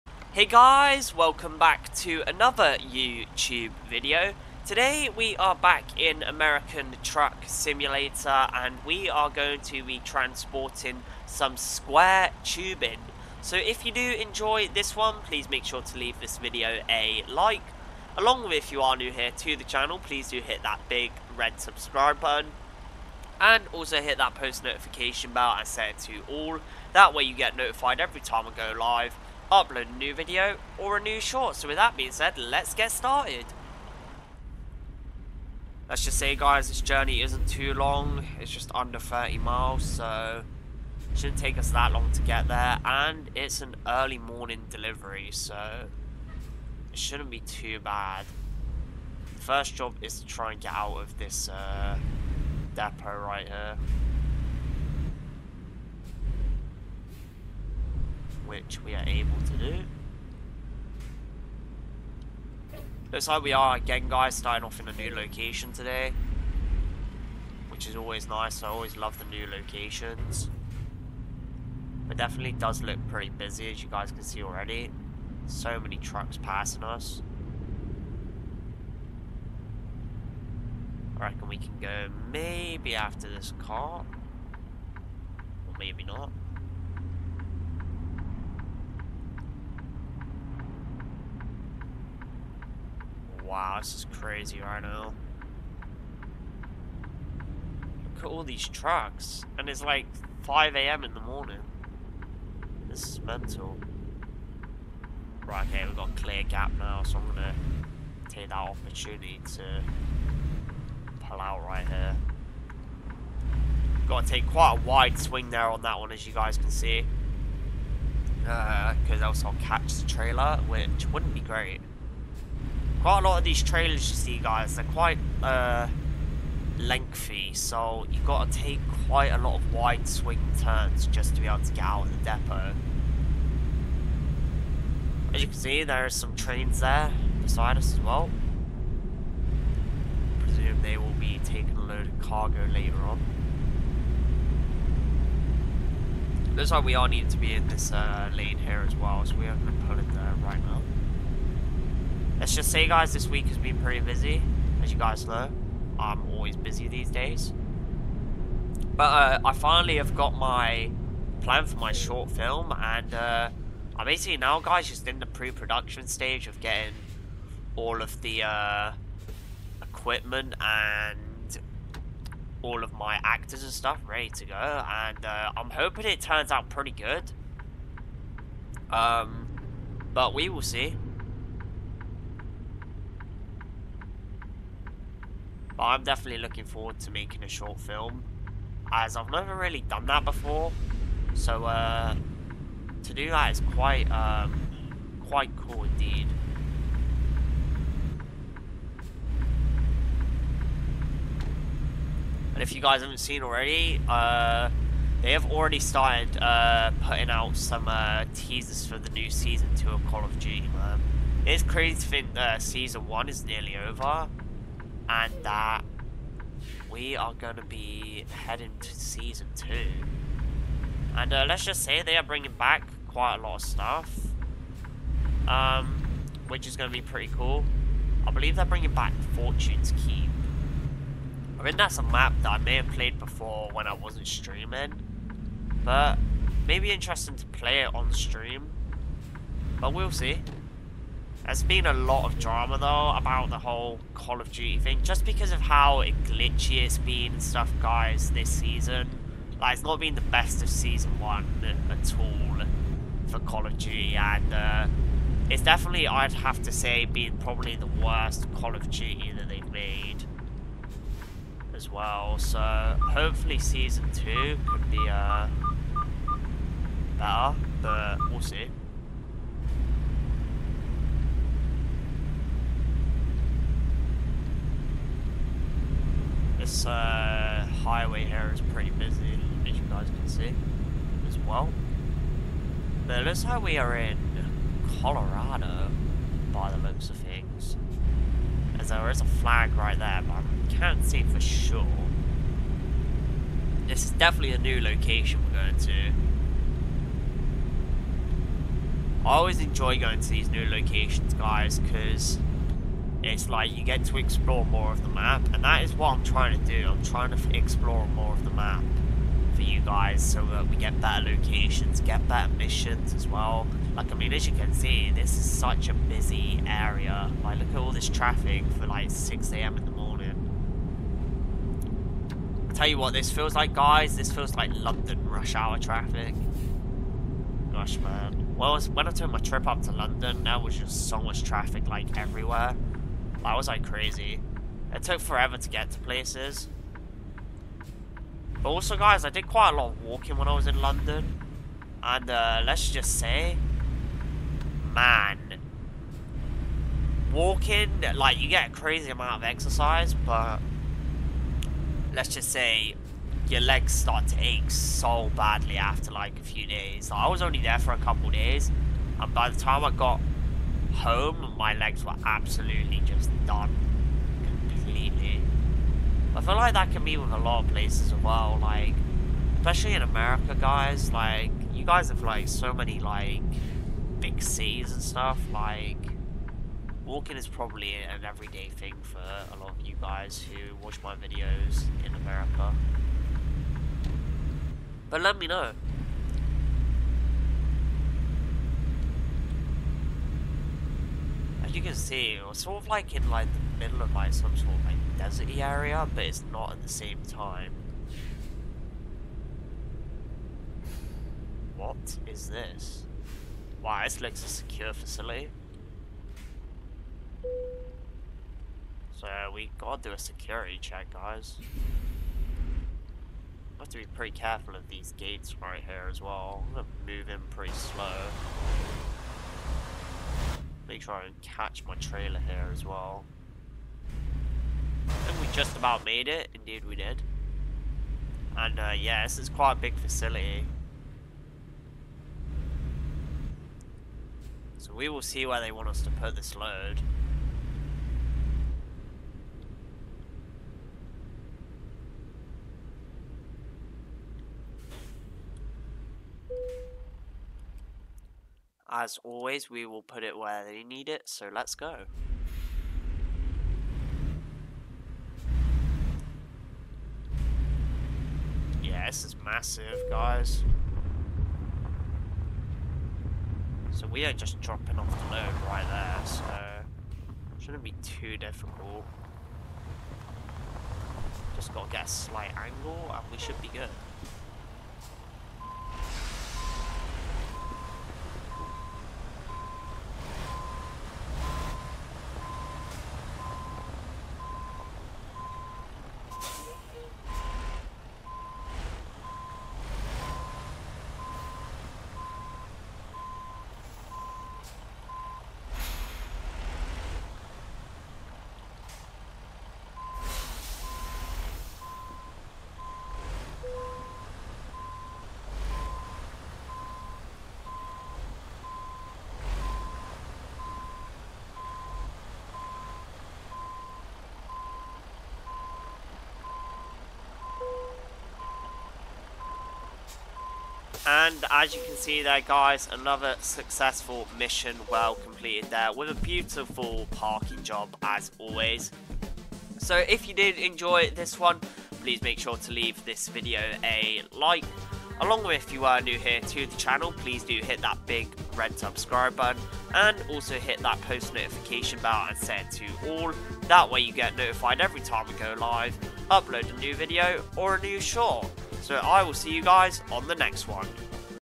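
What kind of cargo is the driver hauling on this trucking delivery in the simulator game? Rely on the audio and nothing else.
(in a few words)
Square tubing.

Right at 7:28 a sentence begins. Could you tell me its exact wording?
As always, we will put it where they need it, so let's go.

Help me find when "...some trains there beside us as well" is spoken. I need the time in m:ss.
2:16.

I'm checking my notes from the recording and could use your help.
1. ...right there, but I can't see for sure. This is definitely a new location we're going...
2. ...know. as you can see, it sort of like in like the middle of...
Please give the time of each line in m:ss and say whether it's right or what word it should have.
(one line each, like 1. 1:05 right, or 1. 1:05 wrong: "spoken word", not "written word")
1. 4:49 right
2. 6:25 right.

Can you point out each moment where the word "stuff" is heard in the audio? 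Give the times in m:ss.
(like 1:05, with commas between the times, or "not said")
2:53, 3:43, 4:07, 6:15.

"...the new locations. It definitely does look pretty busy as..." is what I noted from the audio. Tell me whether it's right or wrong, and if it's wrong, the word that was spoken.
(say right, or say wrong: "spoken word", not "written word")
right.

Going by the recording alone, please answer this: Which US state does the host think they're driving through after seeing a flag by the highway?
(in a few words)
Colorado.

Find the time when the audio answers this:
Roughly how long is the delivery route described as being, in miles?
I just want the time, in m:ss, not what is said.
0:38.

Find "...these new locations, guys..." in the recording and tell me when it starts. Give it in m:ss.
5:00.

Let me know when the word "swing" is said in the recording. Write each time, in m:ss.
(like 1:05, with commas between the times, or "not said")
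1:55, 2:10.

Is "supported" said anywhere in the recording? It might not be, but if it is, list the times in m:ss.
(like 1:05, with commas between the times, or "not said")
not said.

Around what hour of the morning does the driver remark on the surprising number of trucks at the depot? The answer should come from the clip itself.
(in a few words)
5 a.m.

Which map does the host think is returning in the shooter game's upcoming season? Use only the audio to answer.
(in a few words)
Fortune's Keep.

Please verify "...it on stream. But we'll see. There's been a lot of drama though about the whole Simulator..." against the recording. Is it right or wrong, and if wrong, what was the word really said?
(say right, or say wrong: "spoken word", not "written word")
wrong: "Call", not "Simulator".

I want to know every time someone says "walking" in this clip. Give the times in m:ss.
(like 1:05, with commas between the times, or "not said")
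5:40, 5:47, 6:17.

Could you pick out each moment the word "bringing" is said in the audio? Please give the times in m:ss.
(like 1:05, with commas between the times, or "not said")
3:42, 3:48.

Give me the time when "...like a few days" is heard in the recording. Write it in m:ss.
5:56.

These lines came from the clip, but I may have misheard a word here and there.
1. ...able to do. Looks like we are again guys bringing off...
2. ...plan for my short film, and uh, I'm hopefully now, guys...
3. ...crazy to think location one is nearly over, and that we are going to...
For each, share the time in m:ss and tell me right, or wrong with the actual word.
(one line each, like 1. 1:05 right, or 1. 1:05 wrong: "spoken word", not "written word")
1. 0:59 wrong: "starting", not "bringing"
2. 2:41 wrong: "basically", not "hopefully"
3. 3:31 wrong: "season", not "location".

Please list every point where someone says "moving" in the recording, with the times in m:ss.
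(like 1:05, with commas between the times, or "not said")
6:57.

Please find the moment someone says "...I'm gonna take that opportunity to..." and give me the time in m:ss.
1:47.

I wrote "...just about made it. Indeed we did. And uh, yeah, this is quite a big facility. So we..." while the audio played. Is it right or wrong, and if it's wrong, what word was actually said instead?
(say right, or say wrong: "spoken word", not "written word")
right.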